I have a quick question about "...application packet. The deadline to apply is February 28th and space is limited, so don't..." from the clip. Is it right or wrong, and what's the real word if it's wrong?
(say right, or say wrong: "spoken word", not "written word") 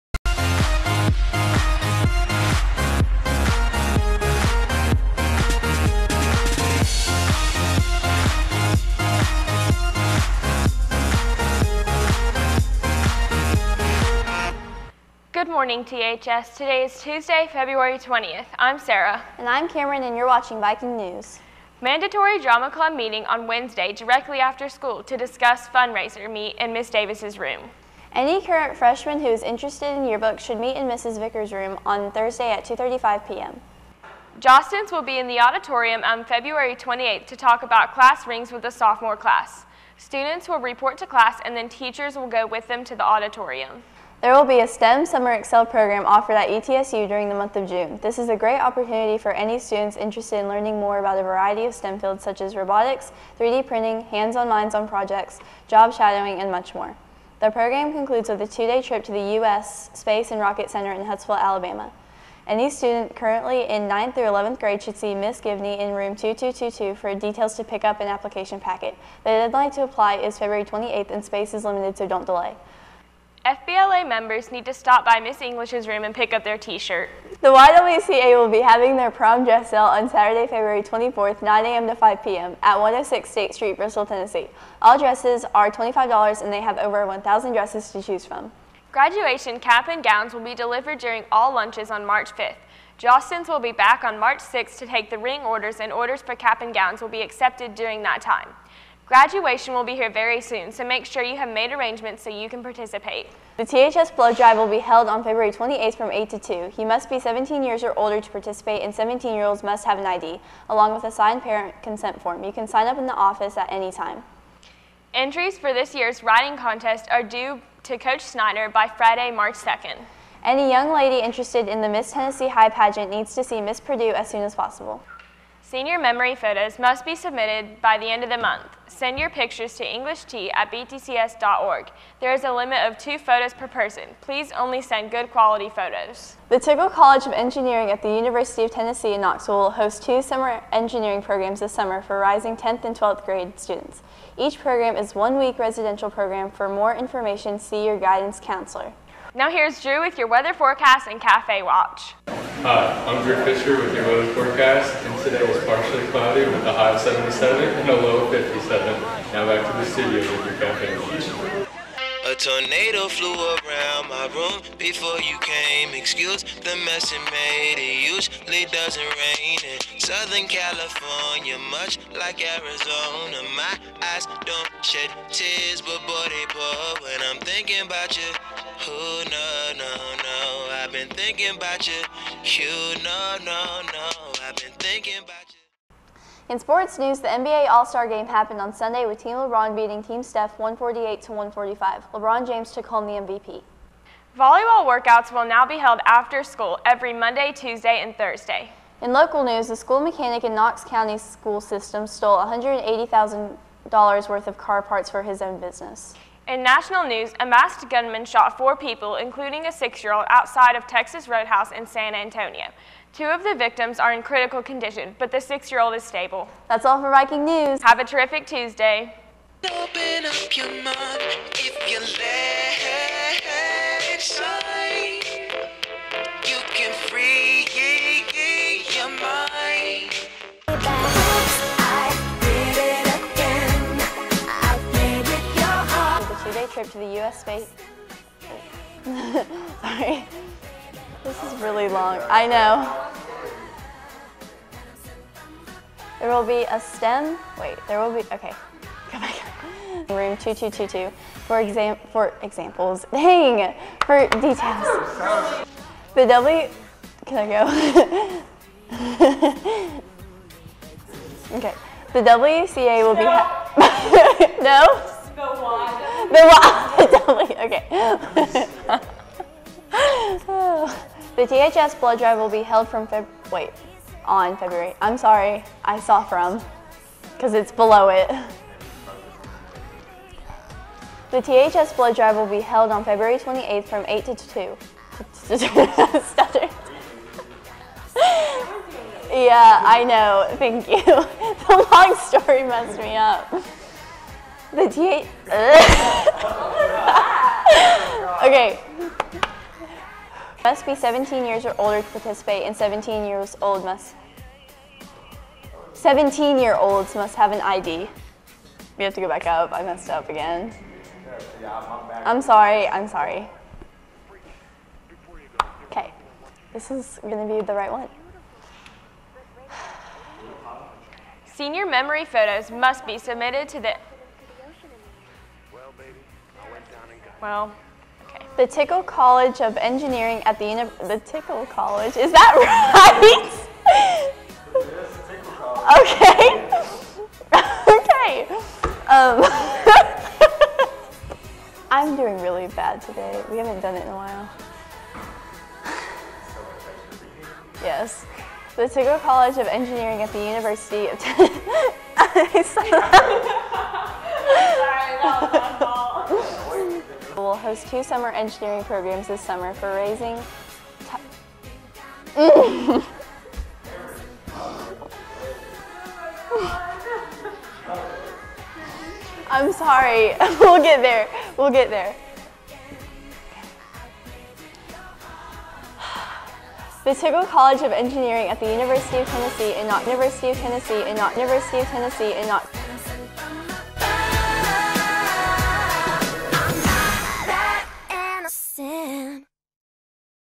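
right.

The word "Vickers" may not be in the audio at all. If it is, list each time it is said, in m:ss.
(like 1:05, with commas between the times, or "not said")
0:31.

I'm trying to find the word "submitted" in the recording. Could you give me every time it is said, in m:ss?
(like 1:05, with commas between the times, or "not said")
2:07, 5:23.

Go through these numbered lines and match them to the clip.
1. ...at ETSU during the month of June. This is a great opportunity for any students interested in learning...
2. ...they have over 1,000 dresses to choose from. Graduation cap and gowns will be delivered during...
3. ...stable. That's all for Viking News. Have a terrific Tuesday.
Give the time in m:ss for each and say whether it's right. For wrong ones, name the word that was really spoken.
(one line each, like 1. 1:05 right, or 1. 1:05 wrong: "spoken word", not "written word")
1. 0:46 right
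2. 1:26 right
3. 3:36 right.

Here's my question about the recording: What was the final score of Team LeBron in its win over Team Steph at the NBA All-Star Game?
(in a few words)
148.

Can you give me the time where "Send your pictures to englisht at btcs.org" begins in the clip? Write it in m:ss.
2:08.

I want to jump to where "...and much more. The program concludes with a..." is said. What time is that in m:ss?
0:56.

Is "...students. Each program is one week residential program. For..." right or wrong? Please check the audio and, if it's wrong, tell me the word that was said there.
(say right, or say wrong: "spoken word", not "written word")
right.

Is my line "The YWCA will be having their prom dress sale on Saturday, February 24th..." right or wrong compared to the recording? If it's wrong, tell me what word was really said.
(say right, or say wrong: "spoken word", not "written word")
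right.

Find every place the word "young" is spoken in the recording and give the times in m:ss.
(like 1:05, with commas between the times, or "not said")
2:00.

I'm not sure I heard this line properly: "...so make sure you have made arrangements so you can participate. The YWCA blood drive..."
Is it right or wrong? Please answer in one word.
wrong.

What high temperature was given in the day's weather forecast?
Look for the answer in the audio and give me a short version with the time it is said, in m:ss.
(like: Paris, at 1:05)
77, at 2:37.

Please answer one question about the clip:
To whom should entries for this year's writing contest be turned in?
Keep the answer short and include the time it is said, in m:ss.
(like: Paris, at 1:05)
Coach Snyder, at 1:57.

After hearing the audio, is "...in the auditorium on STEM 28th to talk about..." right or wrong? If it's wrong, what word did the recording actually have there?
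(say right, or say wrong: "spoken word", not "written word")
wrong: "February", not "STEM".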